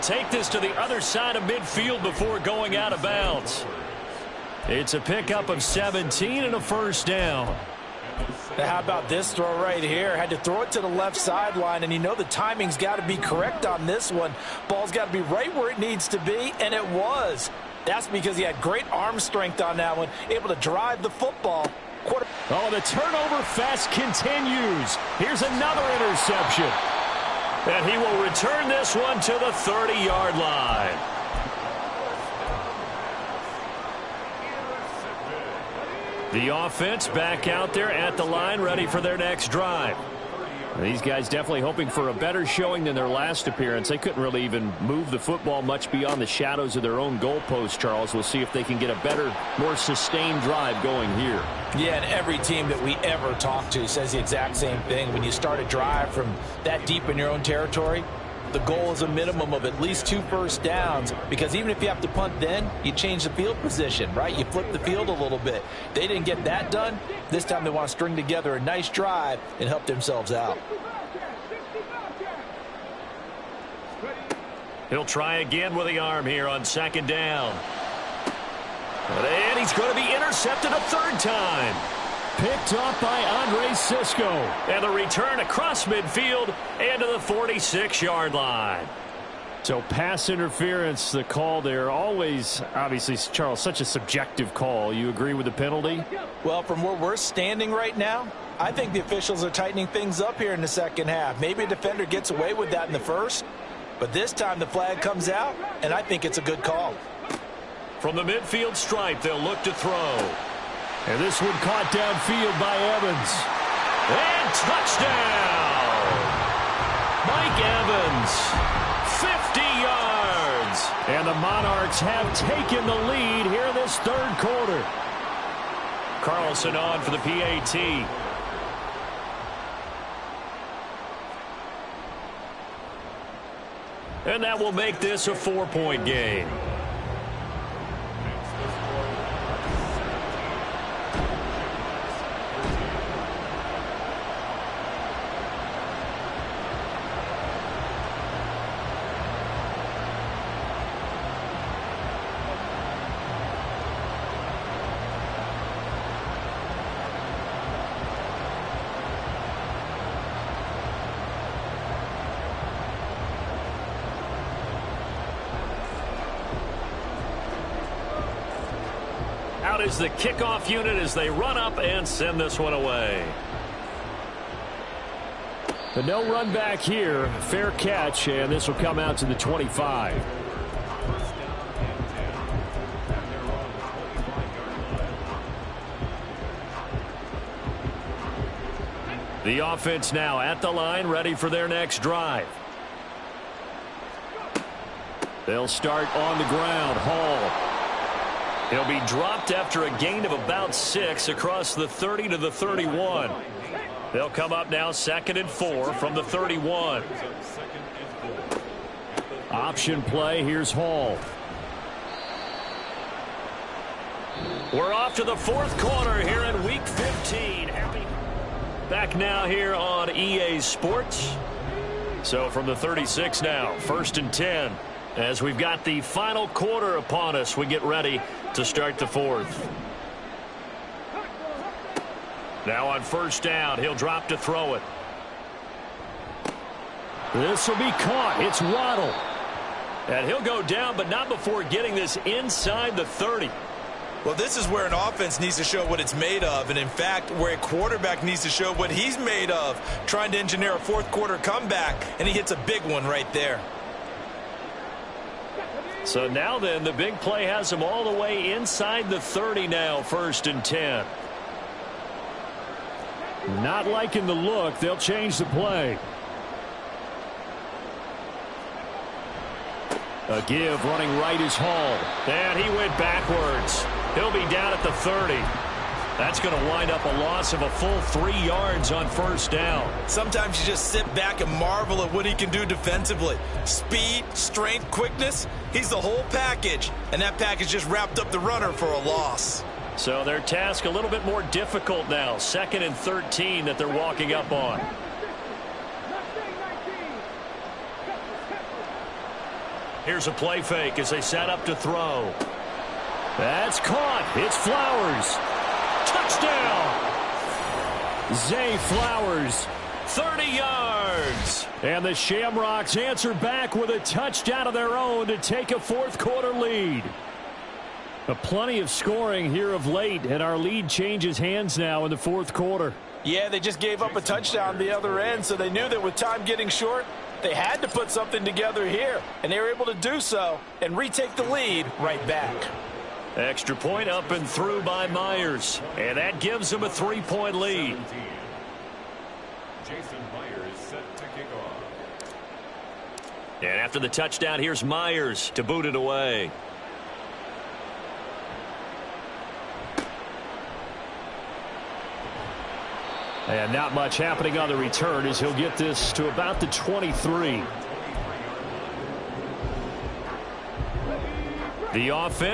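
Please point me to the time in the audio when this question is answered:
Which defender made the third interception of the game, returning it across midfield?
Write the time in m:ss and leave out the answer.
1:23.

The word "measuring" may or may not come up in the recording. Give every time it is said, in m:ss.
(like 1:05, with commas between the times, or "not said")
not said.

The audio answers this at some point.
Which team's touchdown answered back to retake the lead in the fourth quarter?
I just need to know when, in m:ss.
5:12.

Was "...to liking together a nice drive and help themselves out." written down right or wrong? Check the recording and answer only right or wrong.
wrong.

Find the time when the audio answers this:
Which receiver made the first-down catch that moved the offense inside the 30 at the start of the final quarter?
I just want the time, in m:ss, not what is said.
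3:58.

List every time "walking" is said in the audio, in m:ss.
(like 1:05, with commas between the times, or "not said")
4:53.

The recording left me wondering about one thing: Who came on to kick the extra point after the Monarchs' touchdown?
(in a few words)
Carlson.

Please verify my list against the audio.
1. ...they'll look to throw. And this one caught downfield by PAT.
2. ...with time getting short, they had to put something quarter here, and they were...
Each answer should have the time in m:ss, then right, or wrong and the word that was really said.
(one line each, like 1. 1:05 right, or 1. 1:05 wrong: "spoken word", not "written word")
1. 1:49 wrong: "Evans", not "PAT"
2. 5:26 wrong: "together", not "quarter".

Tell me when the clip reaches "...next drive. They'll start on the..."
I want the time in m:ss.
3:11.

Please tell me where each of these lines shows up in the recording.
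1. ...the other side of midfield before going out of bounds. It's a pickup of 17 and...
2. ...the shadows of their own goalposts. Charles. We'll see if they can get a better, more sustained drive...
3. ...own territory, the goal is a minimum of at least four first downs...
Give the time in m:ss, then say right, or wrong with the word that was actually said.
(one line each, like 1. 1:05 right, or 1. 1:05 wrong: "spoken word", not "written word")
1. 0:00 right
2. 0:46 right
3. 0:57 wrong: "two", not "four".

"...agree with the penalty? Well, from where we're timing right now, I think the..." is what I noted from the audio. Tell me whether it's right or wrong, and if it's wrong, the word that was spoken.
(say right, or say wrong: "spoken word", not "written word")
wrong: "standing", not "timing".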